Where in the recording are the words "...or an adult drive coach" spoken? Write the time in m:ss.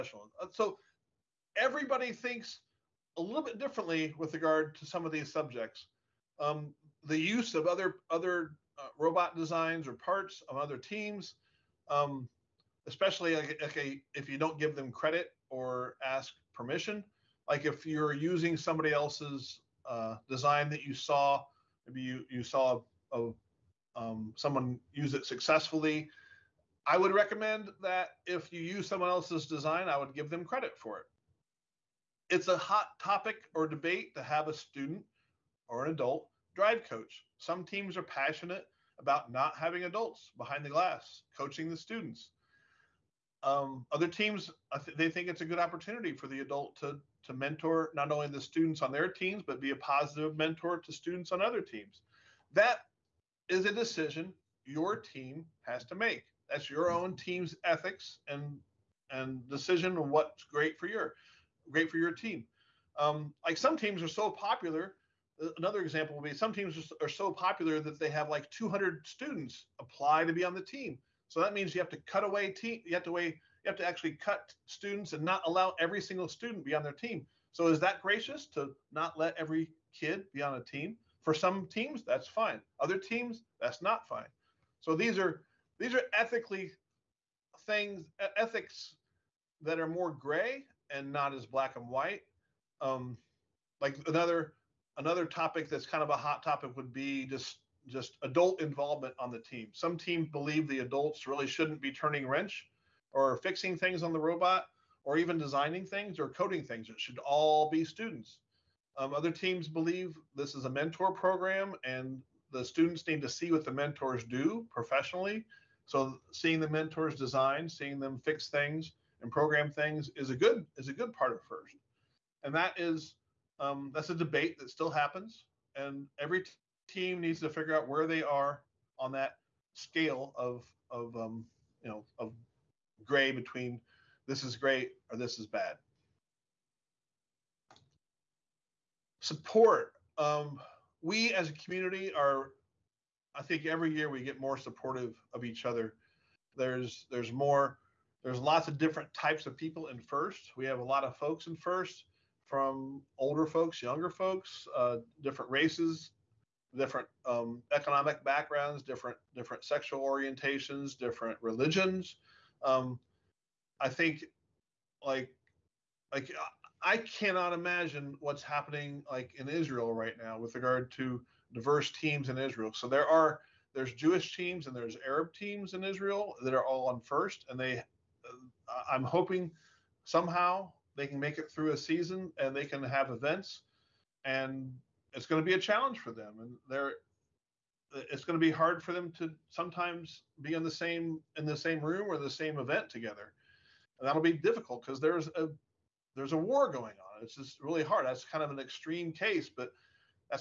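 0:35.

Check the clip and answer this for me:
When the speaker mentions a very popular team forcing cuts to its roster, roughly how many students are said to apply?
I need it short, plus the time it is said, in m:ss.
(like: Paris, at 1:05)
200, at 1:08.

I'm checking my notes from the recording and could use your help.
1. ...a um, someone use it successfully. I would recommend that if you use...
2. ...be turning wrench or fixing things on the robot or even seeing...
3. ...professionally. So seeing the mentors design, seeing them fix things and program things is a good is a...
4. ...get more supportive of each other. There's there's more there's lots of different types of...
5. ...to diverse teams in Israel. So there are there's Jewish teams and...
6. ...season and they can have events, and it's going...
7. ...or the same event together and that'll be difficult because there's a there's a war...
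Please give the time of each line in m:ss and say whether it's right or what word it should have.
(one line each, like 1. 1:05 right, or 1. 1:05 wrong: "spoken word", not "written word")
1. 0:23 right
2. 1:41 wrong: "designing", not "seeing"
3. 1:54 right
4. 2:24 right
5. 2:50 right
6. 3:01 right
7. 3:12 right.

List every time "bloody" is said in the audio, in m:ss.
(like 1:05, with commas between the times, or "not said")
not said.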